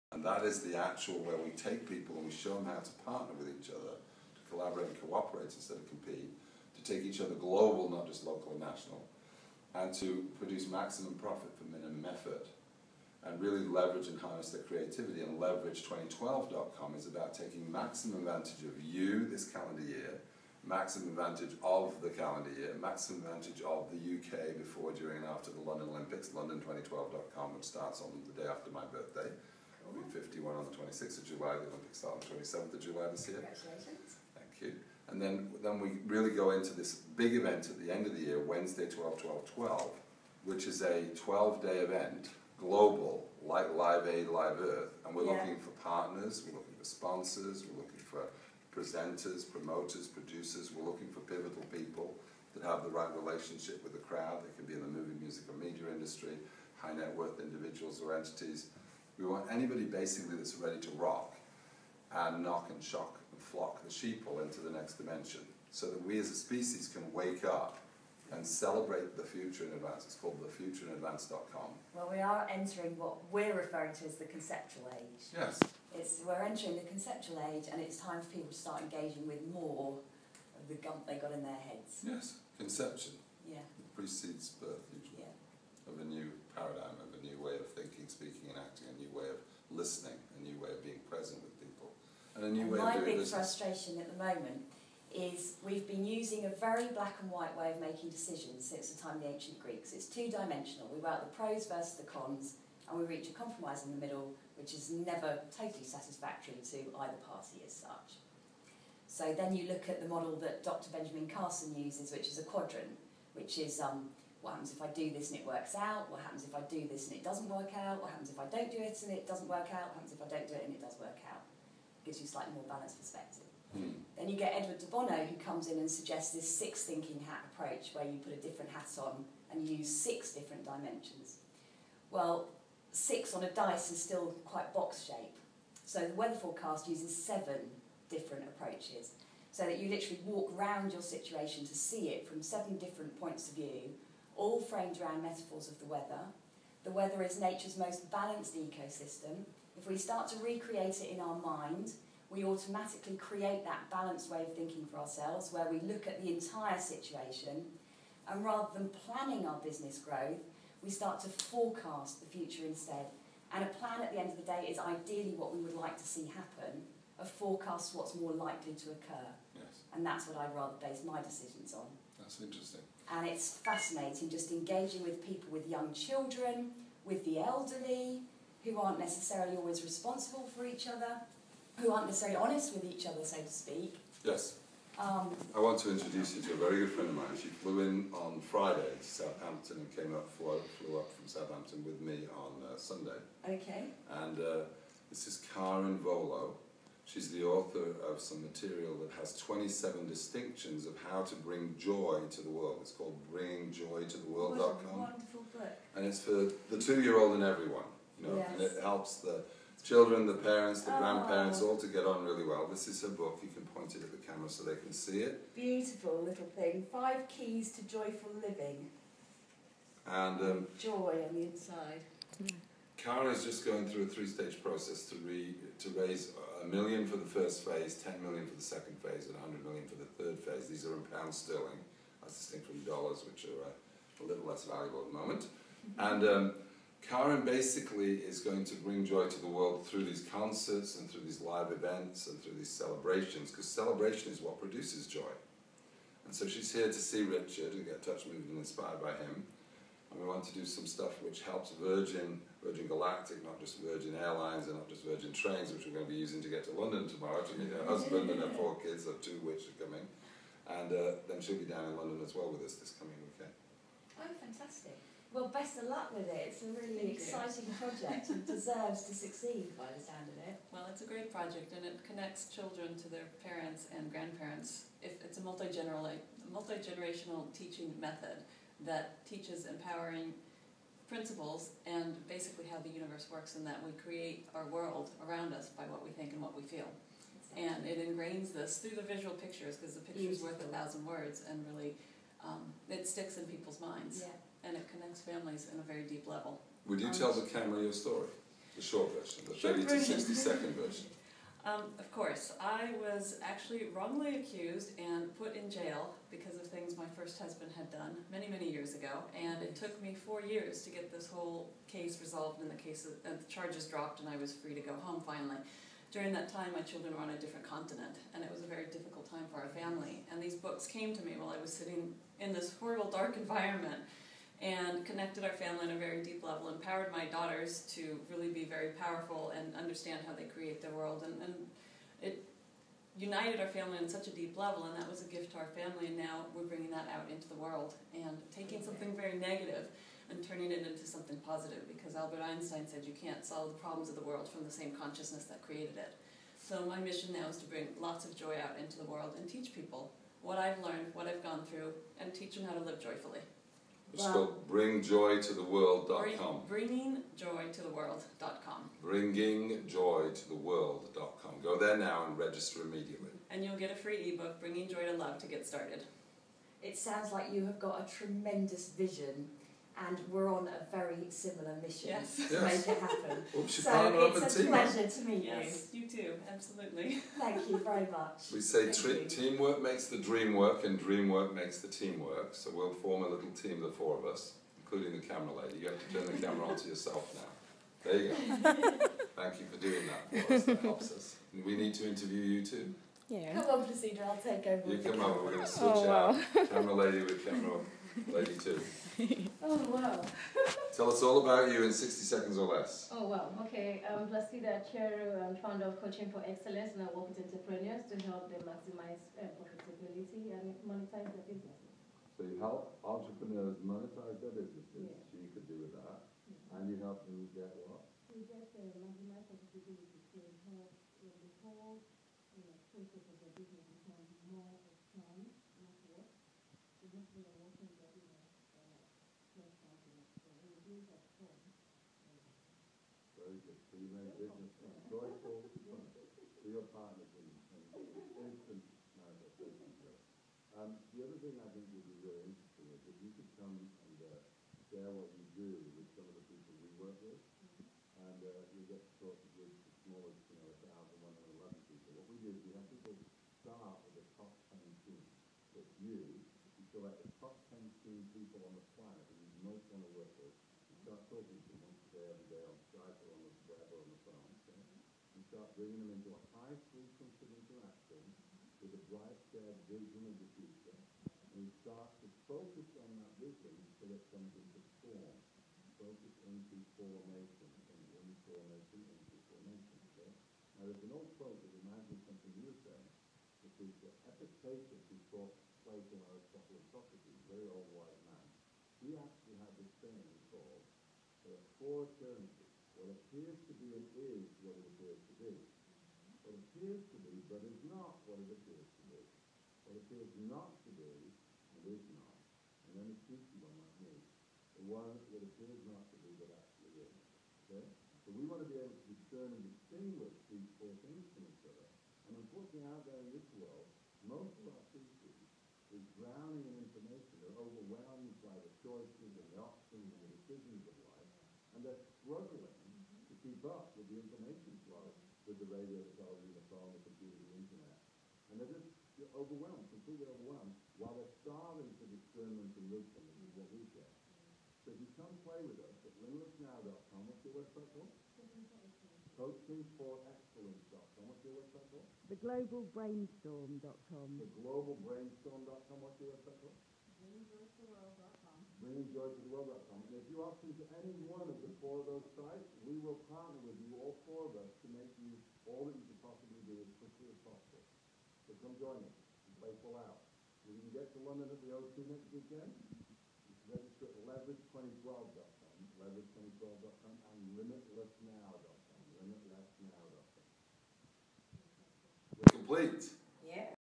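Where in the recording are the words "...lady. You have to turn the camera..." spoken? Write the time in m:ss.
6:25.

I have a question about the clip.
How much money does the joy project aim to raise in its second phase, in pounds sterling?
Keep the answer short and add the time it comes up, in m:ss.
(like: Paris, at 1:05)
10 million, at 3:47.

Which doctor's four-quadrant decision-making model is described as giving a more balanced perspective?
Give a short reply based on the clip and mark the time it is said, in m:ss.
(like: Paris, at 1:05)
Dr. Benjamin Carson, at 1:50.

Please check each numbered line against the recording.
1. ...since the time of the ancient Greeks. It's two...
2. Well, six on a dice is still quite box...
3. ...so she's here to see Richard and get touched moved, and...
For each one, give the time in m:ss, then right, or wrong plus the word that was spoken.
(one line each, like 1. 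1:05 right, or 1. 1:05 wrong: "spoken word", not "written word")
1. 1:38 right
2. 2:12 right
3. 4:06 right.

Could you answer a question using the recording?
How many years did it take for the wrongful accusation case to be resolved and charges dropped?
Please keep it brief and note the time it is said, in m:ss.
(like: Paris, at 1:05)
four years, at 5:10.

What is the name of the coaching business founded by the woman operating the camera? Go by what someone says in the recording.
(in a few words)
Coaching for Excellence.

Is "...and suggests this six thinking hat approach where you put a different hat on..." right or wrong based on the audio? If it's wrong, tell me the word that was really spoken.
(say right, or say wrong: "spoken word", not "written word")
right.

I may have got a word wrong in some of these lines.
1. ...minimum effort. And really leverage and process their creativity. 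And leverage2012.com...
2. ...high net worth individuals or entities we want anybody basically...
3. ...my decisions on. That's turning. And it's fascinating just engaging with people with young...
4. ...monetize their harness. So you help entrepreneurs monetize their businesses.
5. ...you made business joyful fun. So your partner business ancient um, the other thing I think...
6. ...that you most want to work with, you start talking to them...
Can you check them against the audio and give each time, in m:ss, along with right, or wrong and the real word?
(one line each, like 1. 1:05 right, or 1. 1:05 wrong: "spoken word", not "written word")
1. 0:11 wrong: "harness", not "process"
2. 0:56 right
3. 2:51 wrong: "interesting", not "turning"
4. 6:50 wrong: "business", not "harness"
5. 7:13 wrong: "instant", not "ancient"
6. 7:39 right.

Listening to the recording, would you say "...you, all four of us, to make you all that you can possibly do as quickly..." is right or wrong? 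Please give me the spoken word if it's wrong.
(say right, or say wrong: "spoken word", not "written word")
right.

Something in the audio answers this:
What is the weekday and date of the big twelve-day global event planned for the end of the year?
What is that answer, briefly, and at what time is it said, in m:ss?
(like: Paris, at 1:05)
Wednesday 12 12 12, at 0:38.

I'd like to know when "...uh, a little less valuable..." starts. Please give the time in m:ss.
3:53.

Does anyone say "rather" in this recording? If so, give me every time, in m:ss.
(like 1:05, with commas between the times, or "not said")
2:38, 2:50.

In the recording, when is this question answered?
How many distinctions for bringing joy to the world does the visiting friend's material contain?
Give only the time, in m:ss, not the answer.
3:19.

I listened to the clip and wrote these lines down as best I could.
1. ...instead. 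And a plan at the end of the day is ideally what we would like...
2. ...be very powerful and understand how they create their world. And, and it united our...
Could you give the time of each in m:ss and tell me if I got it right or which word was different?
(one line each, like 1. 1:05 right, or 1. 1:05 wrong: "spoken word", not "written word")
1. 2:42 right
2. 5:28 right.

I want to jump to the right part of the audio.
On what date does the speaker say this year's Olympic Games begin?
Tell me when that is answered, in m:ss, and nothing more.
0:32.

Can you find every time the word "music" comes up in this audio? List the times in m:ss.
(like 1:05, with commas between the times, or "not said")
0:55.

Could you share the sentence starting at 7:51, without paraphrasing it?
And you start to focus on that vision until it comes into form.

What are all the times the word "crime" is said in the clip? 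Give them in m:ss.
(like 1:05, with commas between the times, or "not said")
not said.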